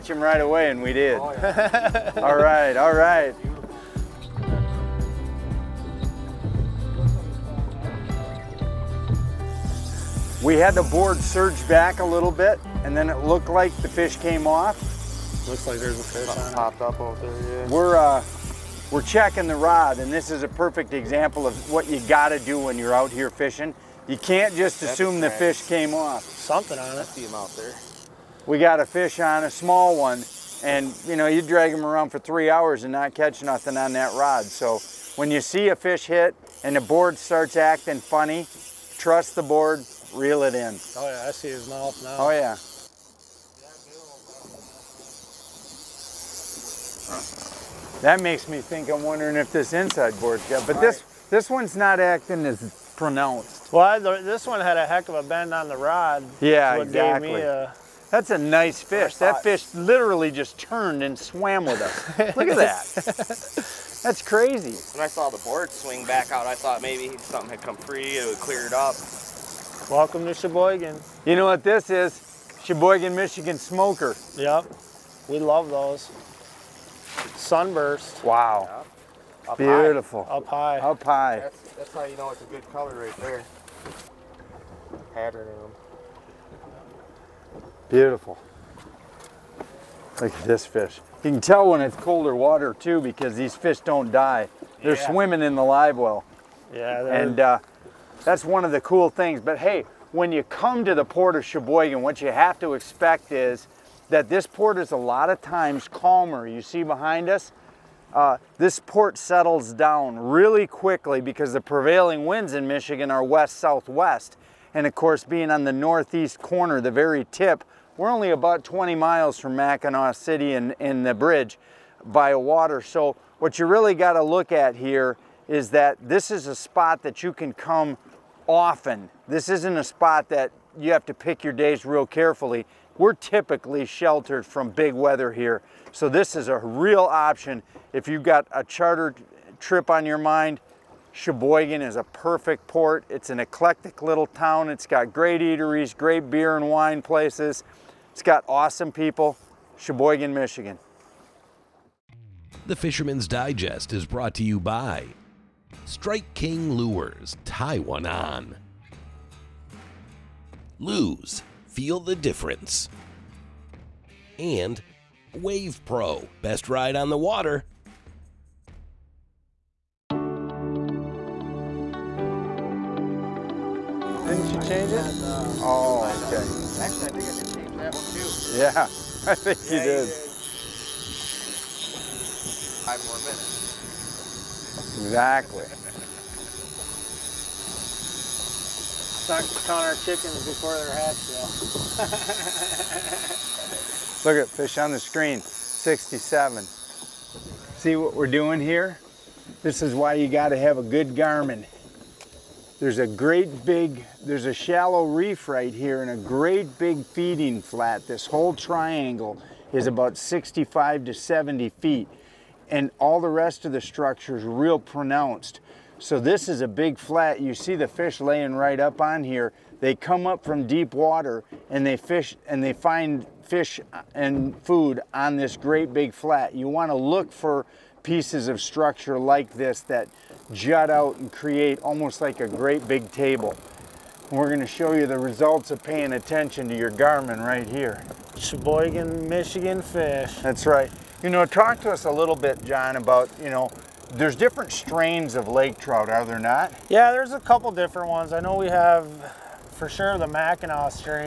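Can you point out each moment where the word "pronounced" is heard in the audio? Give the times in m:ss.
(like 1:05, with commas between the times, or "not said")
0:52, 3:34.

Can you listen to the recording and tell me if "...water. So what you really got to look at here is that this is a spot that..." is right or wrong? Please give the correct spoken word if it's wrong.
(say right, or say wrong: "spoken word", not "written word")
right.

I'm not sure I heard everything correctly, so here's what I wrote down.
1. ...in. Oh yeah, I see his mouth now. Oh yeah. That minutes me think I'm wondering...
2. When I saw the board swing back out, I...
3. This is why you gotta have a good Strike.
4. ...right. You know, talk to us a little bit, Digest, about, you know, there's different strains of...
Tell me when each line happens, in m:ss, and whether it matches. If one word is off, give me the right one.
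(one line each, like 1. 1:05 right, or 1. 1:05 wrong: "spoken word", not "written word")
1. 0:40 wrong: "makes", not "minutes"
2. 1:04 right
3. 3:19 wrong: "Garmin", not "Strike"
4. 4:00 wrong: "John", not "Digest".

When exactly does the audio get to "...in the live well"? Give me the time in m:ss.
1:35.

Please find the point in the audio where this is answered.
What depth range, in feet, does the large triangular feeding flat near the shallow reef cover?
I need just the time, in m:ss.
3:30.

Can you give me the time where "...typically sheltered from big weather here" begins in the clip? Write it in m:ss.
2:13.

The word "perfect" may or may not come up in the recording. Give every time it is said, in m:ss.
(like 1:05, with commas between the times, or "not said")
0:20, 2:22.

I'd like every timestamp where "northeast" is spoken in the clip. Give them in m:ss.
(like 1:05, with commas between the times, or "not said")
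1:55.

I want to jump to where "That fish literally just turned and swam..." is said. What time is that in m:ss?
0:59.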